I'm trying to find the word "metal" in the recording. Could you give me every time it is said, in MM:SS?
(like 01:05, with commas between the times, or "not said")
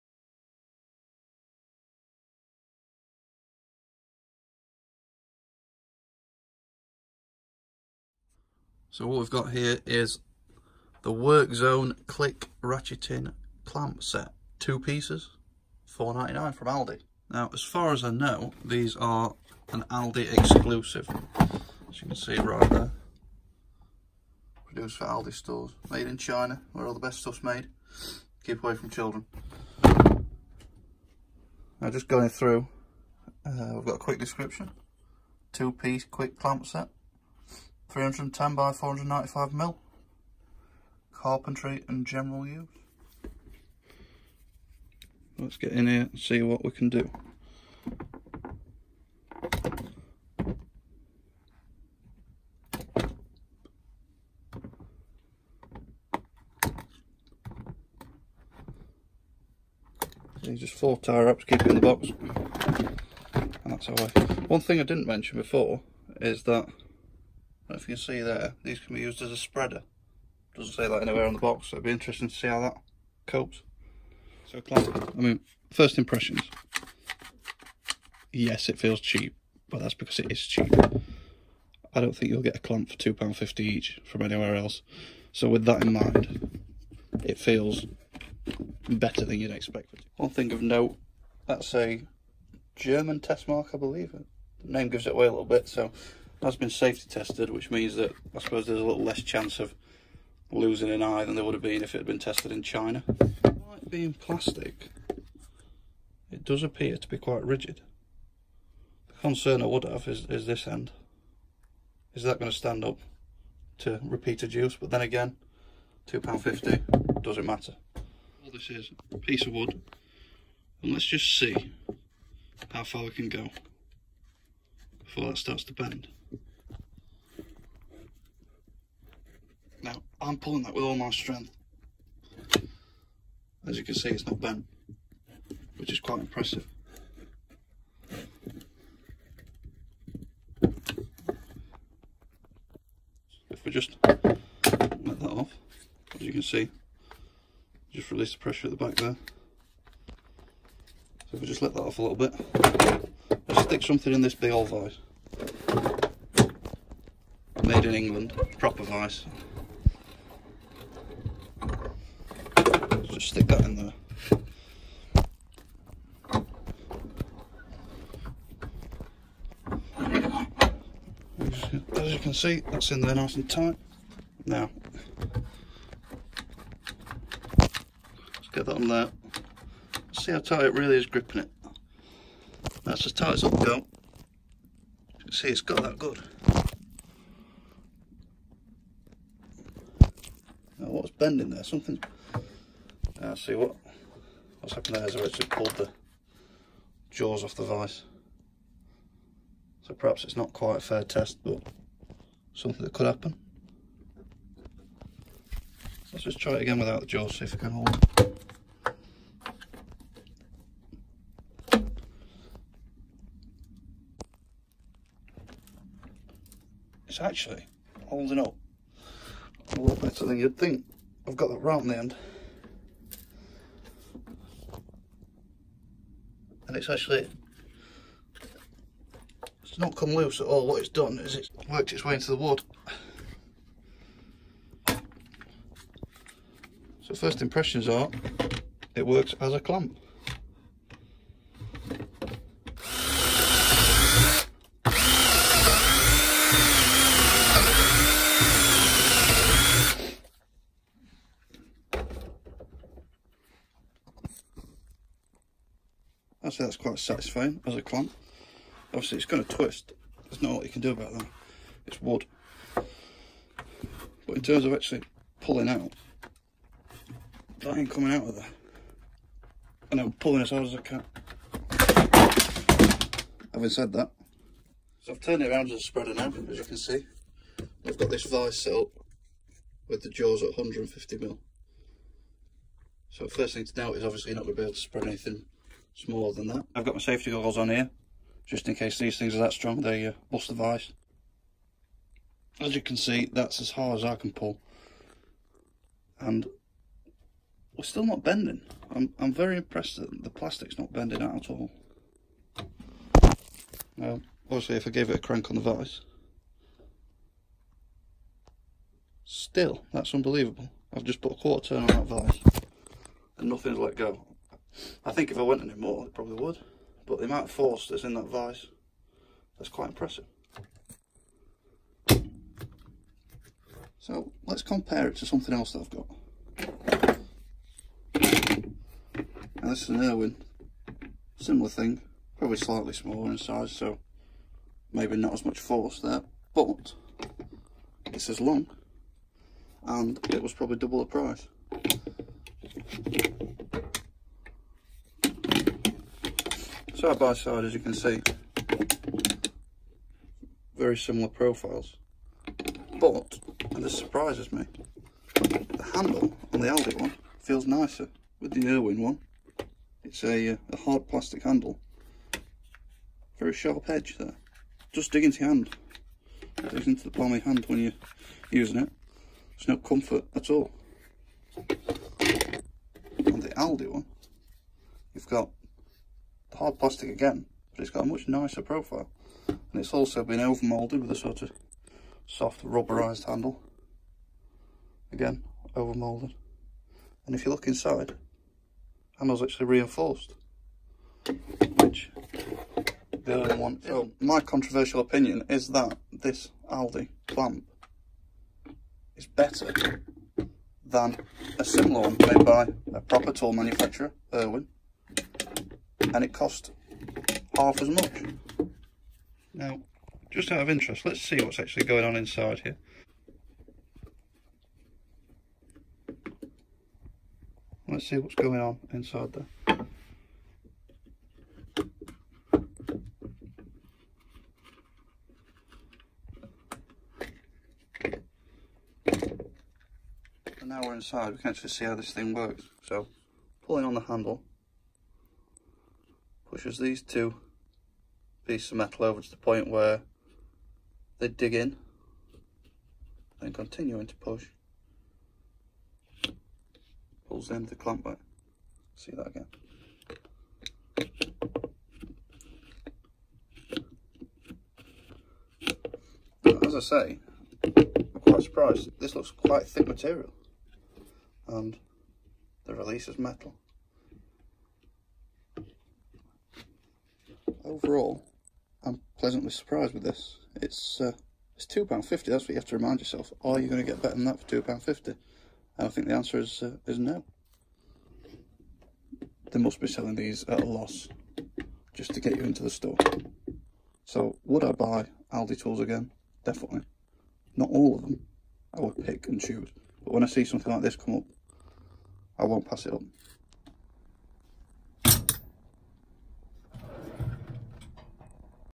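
07:18, 07:43.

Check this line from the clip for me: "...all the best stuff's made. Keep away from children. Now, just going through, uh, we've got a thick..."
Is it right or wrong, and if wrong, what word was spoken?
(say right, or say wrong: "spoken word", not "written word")
wrong: "quick", not "thick".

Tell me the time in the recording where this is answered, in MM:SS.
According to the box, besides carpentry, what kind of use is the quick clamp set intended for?
00:42.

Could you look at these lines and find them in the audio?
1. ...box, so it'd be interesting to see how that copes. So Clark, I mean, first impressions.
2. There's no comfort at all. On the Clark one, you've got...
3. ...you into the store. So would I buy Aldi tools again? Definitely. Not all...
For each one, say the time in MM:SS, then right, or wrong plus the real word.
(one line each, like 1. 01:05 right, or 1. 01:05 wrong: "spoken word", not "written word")
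1. 01:11 right
2. 06:09 wrong: "Aldi", not "Clark"
3. 08:02 right.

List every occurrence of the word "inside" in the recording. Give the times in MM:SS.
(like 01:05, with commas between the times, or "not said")
06:27, 06:52, 06:58, 07:10.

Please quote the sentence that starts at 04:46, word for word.
I've got my safety goggles on here, just in case these things are that strong, they uh, bust the vise.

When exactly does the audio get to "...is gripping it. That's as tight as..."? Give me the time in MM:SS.
03:00.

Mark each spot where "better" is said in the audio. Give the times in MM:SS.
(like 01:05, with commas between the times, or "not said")
01:28, 03:40, 06:39, 07:54.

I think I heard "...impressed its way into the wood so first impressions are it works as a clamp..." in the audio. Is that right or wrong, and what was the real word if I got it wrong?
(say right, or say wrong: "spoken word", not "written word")
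wrong: "worked", not "impressed".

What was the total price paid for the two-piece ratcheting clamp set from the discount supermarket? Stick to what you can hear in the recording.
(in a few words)
4.99.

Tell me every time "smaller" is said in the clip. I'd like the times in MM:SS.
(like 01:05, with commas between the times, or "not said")
04:45, 05:32.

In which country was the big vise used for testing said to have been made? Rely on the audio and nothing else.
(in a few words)
England.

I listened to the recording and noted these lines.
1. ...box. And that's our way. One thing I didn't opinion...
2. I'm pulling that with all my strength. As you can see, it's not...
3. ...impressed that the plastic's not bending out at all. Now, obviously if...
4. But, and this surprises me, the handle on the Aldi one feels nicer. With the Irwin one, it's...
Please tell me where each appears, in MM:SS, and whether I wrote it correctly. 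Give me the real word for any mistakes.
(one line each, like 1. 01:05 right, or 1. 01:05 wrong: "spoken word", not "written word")
1. 01:01 wrong: "mention", not "opinion"
2. 02:10 right
3. 04:59 right
4. 05:52 right.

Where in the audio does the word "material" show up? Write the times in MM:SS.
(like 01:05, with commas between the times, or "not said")
07:39.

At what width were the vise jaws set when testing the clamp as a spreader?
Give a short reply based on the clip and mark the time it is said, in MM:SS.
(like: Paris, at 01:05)
150mm, at 04:40.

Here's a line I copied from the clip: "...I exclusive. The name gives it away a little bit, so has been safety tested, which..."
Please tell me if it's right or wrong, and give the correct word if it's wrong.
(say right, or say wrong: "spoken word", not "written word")
wrong: "believe", not "exclusive".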